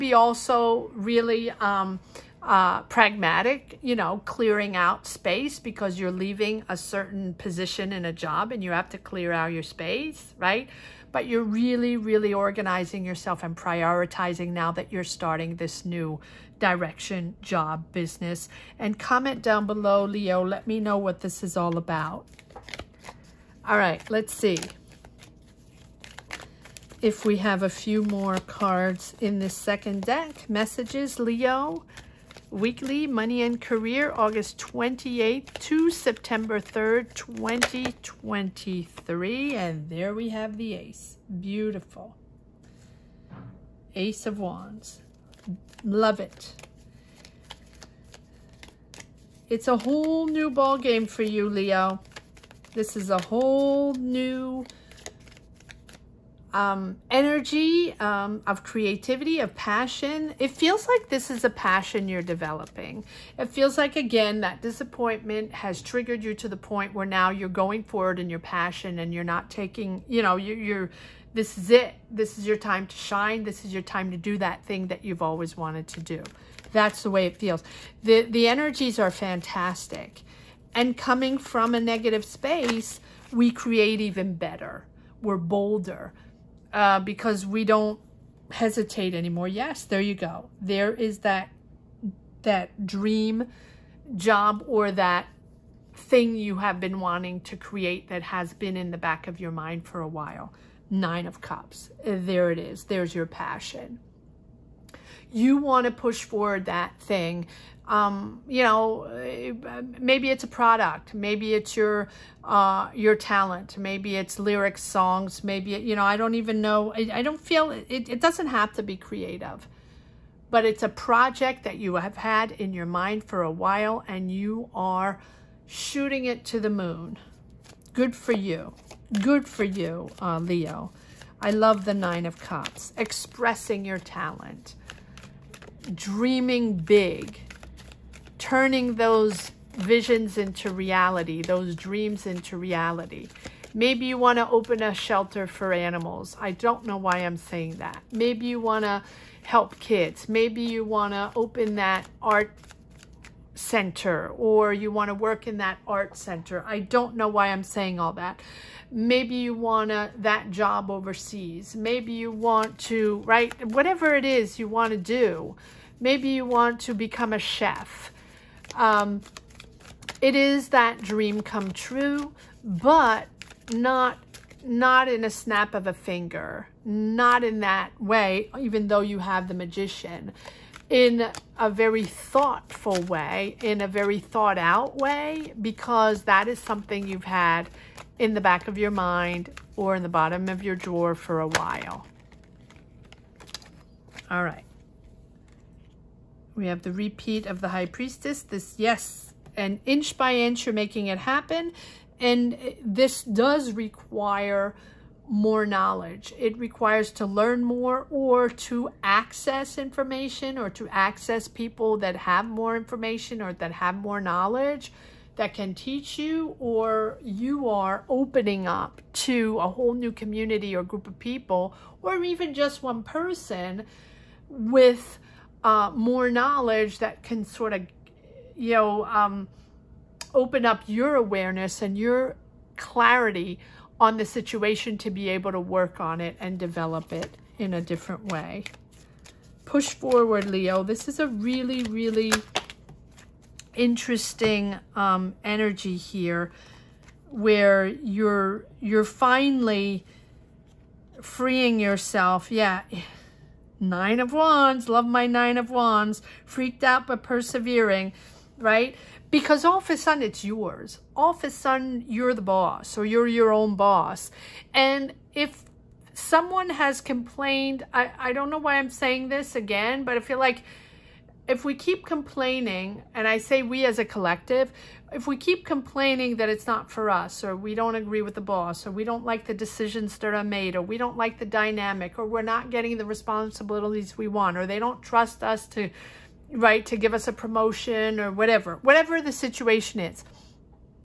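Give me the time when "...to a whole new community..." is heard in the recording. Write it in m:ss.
3:39.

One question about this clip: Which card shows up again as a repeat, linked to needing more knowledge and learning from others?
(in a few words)
High Priestess.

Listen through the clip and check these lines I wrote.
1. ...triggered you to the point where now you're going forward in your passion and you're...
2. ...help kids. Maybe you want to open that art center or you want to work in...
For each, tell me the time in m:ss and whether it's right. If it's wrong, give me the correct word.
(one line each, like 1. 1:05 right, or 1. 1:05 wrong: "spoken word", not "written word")
1. 1:05 right
2. 2:29 right.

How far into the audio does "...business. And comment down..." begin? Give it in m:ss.
0:17.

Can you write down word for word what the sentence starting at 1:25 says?
We're bolder uh, because we don't hesitate anymore.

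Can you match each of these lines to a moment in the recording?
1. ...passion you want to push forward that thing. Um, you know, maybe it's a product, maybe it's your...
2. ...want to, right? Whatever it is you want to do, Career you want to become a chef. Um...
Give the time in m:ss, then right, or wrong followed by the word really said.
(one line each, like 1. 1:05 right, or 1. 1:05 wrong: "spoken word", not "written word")
1. 1:43 right
2. 2:42 wrong: "Maybe", not "Career".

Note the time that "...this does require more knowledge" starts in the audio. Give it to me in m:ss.
3:22.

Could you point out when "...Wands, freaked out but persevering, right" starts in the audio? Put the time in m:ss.
4:15.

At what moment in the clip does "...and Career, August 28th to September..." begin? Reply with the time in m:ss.
0:33.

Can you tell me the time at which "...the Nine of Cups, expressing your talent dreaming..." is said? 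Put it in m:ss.
2:11.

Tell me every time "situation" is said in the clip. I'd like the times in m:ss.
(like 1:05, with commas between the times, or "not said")
3:54, 4:49.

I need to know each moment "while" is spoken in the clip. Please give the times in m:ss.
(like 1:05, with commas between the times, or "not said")
1:40, 2:03, 3:11.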